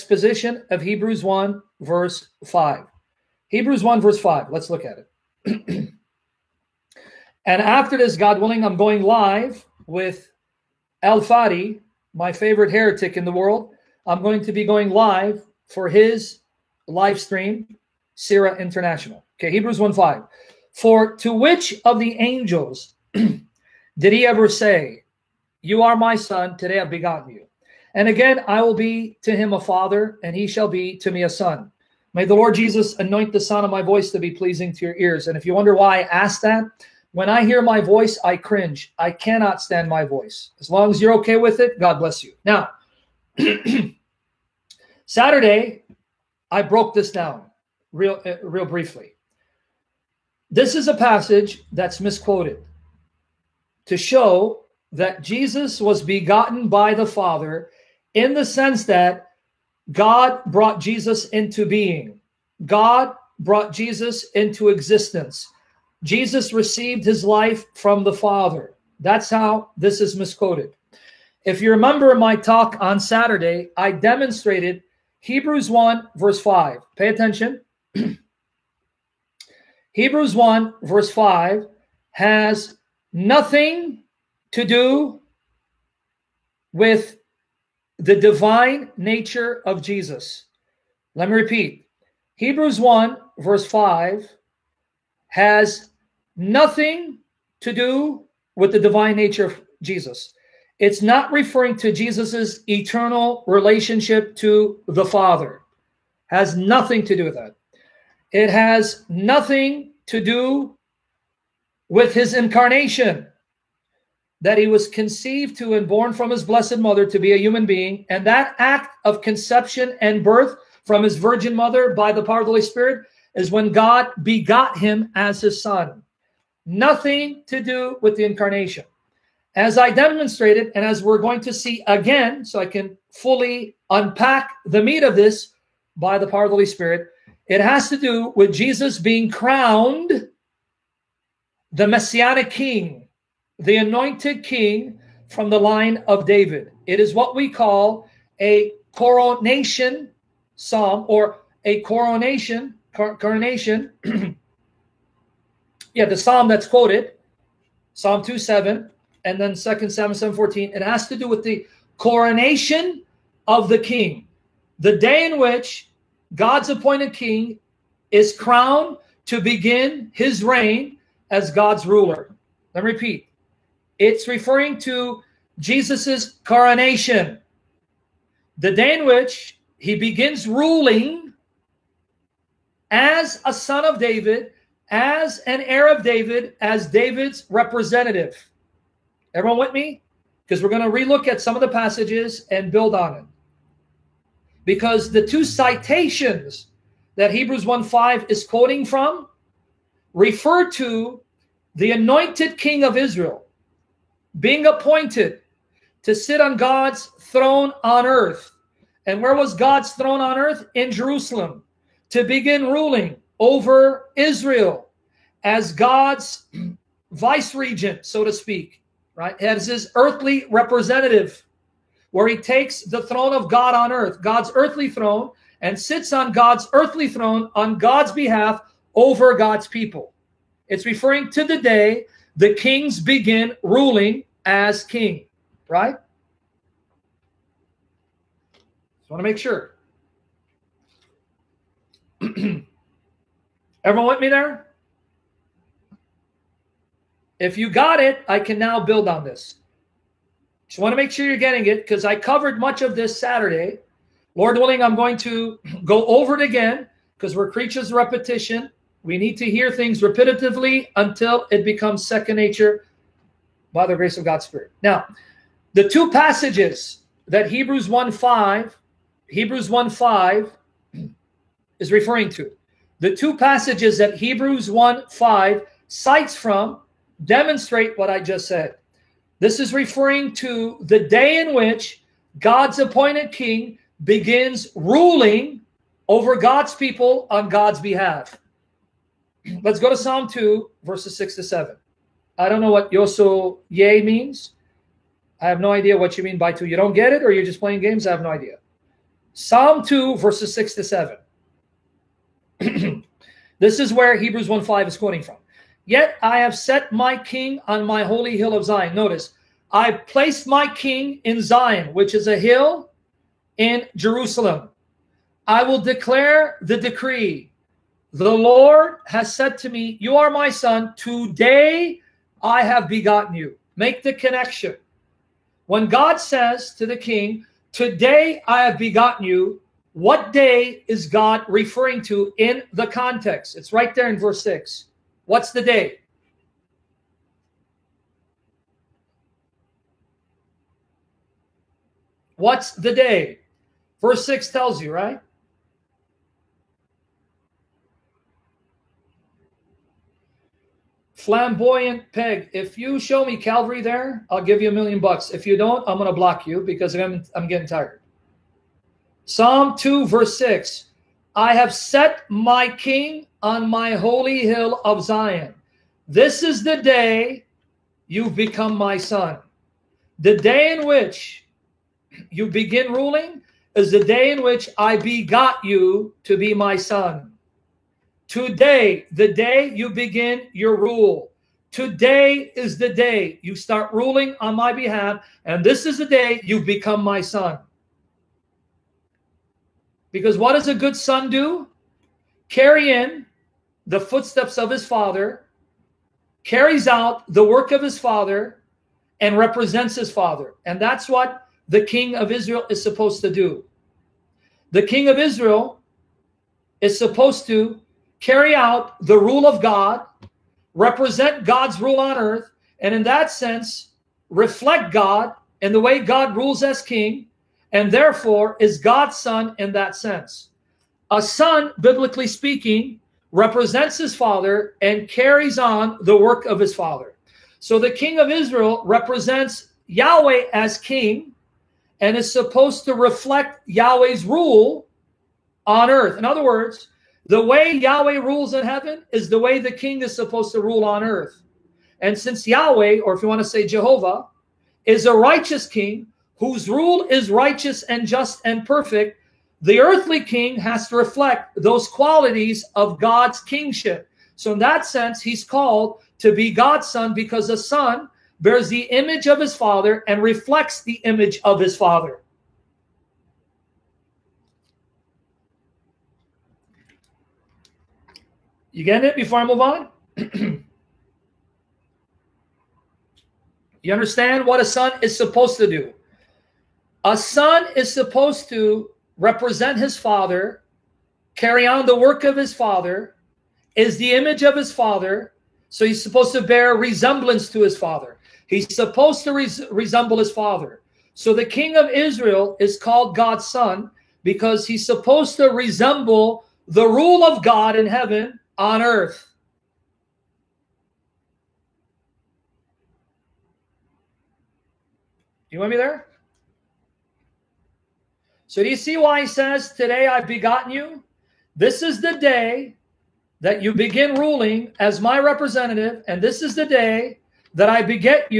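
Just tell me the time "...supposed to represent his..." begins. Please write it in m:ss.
7:57.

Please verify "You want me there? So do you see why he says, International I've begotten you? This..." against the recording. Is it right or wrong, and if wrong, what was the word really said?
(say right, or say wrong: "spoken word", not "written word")
wrong: "Today", not "International".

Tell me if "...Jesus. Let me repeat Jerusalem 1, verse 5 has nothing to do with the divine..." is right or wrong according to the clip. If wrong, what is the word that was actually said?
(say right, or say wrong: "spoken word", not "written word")
wrong: "Hebrews", not "Jerusalem".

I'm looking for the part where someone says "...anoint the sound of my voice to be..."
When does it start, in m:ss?
0:32.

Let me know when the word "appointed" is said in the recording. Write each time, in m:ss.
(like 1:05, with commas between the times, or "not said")
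2:46, 3:24, 4:42.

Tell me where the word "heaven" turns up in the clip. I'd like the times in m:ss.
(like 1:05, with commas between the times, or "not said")
7:18, 8:17.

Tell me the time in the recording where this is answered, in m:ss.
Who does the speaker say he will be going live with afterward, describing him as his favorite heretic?
0:11.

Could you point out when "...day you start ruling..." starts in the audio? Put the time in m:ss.
6:22.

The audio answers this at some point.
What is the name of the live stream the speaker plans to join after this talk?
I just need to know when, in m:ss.
0:18.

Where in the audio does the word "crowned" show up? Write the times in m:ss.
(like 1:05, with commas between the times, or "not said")
2:19, 2:48.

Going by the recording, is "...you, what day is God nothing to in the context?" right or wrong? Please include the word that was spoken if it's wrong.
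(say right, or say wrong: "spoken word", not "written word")
wrong: "referring", not "nothing".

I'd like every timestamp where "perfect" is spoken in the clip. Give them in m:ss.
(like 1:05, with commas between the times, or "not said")
7:28.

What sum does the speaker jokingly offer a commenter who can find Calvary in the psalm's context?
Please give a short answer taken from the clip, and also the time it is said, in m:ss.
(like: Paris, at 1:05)
a million bucks, at 5:54.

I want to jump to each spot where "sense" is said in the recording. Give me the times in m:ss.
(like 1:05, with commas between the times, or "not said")
0:58, 6:53, 6:59, 7:34.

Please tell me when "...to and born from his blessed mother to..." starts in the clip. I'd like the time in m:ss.
1:55.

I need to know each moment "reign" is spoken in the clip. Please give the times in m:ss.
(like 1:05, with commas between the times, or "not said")
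2:50.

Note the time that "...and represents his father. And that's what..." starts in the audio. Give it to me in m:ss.
6:39.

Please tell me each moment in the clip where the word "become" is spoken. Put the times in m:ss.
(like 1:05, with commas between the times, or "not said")
4:21, 6:08, 6:26.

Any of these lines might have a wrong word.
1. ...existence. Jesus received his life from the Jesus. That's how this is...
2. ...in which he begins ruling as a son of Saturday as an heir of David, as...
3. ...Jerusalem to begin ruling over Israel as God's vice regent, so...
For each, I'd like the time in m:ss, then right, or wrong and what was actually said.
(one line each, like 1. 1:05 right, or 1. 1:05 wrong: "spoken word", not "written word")
1. 1:04 wrong: "Father", not "Jesus"
2. 2:58 wrong: "David", not "Saturday"
3. 3:30 right.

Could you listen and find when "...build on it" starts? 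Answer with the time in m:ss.
3:12.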